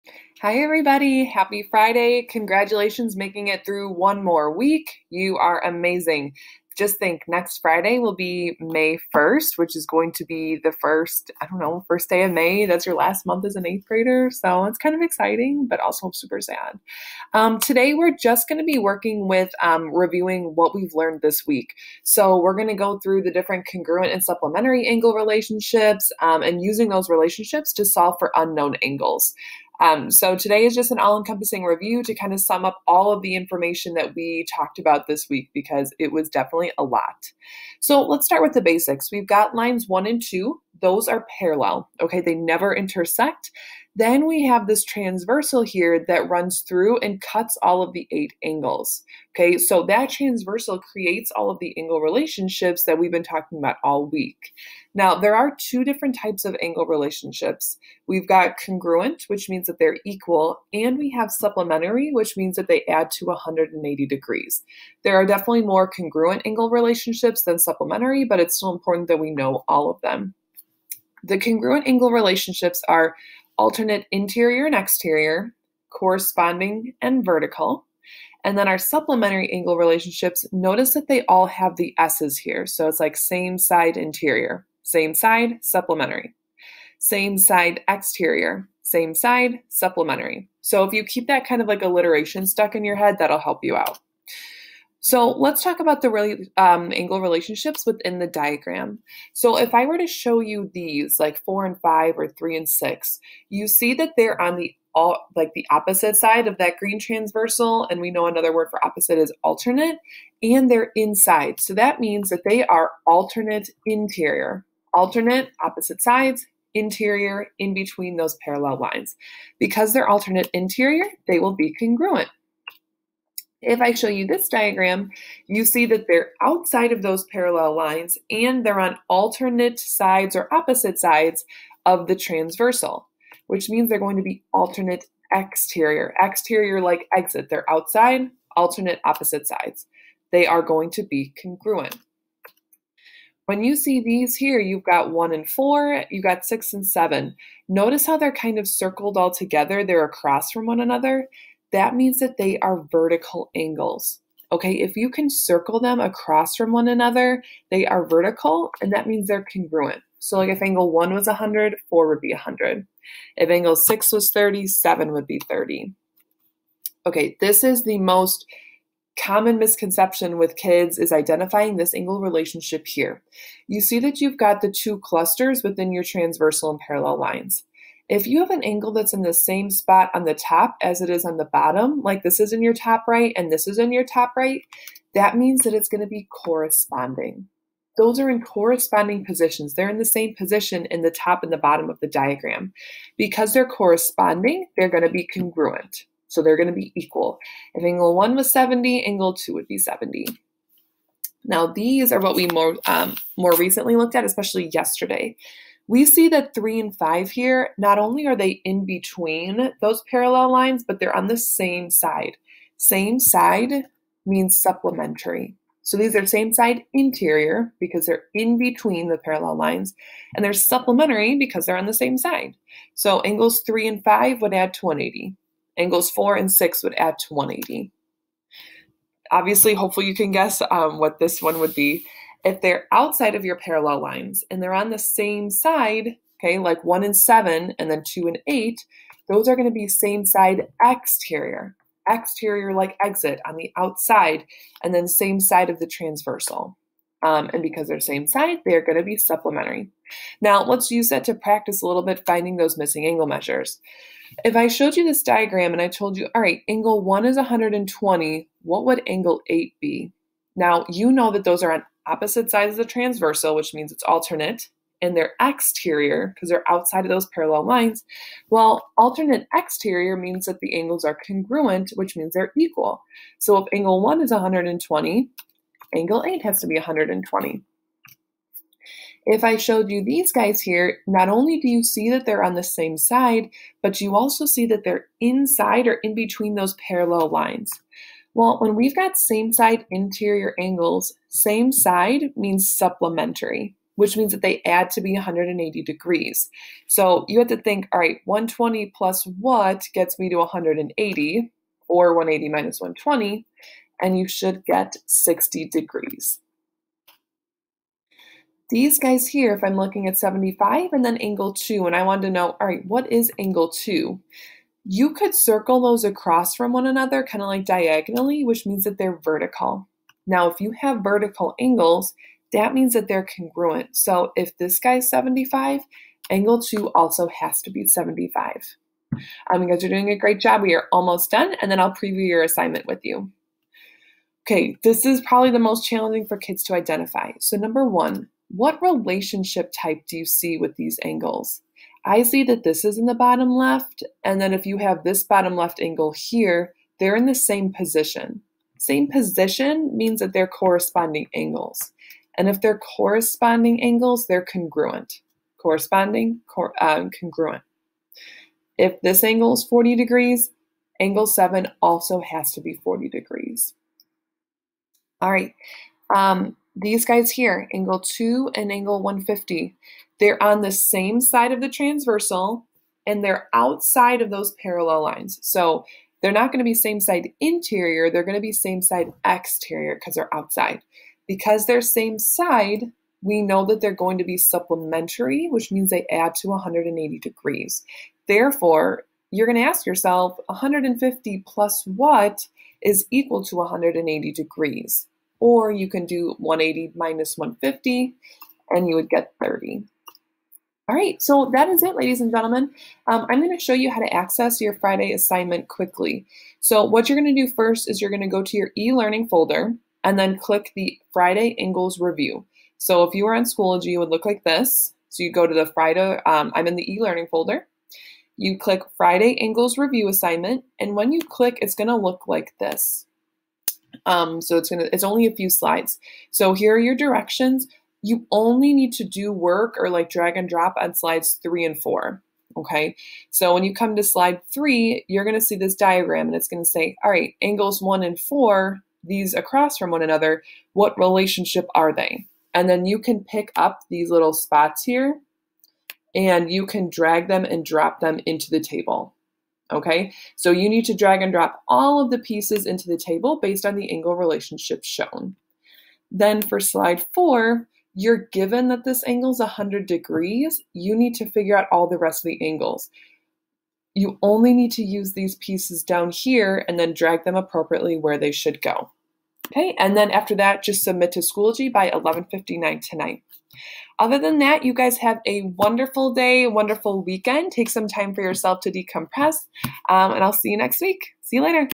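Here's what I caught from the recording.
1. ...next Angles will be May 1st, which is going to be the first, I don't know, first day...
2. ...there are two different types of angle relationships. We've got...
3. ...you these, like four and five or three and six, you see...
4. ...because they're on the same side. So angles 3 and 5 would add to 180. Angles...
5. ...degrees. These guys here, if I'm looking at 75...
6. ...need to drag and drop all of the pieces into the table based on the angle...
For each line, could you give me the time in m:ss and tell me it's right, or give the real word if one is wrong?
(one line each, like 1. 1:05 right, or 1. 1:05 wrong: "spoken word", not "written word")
1. 0:07 wrong: "Friday", not "Angles"
2. 0:55 right
3. 1:40 right
4. 3:41 right
5. 5:05 right
6. 7:30 right.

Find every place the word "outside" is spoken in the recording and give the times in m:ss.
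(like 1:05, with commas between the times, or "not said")
2:06, 2:17, 3:52, 4:03, 4:26, 6:13, 6:20.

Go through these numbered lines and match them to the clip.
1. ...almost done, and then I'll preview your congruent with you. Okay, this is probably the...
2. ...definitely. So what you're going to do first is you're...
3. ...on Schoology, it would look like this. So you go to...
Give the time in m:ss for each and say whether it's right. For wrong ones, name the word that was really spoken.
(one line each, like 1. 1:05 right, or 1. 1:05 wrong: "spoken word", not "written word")
1. 5:30 wrong: "assignment", not "congruent"
2. 6:45 wrong: "quickly", not "definitely"
3. 6:53 right.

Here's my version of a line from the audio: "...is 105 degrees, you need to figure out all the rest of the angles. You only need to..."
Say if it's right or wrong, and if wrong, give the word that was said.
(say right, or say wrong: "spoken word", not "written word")
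wrong: "100", not "105".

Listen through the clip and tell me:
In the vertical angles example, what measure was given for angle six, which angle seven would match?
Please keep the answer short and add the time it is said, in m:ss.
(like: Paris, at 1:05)
30, at 2:44.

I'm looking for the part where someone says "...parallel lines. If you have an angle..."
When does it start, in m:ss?
2:56.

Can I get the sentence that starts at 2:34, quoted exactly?
Okay, if you can circle them across from one another, they are vertical and that means they're congruent.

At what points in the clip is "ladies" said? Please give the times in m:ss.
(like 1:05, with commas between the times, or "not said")
6:41.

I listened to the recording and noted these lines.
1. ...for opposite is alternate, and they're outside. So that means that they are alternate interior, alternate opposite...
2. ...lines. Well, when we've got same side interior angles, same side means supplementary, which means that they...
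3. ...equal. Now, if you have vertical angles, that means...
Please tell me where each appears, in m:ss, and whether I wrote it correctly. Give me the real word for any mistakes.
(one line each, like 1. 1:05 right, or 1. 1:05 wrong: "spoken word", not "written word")
1. 1:48 wrong: "inside", not "outside"
2. 4:47 right
3. 5:19 wrong: "vertical", not "equal".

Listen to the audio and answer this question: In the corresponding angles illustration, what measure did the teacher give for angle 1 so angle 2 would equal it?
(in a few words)
70.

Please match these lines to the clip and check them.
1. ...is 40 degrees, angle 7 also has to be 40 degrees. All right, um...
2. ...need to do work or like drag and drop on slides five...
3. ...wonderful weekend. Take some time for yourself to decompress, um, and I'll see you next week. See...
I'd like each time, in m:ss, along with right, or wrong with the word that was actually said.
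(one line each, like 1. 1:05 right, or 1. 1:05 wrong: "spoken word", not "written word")
1. 5:59 right
2. 7:08 wrong: "three", not "five"
3. 7:56 right.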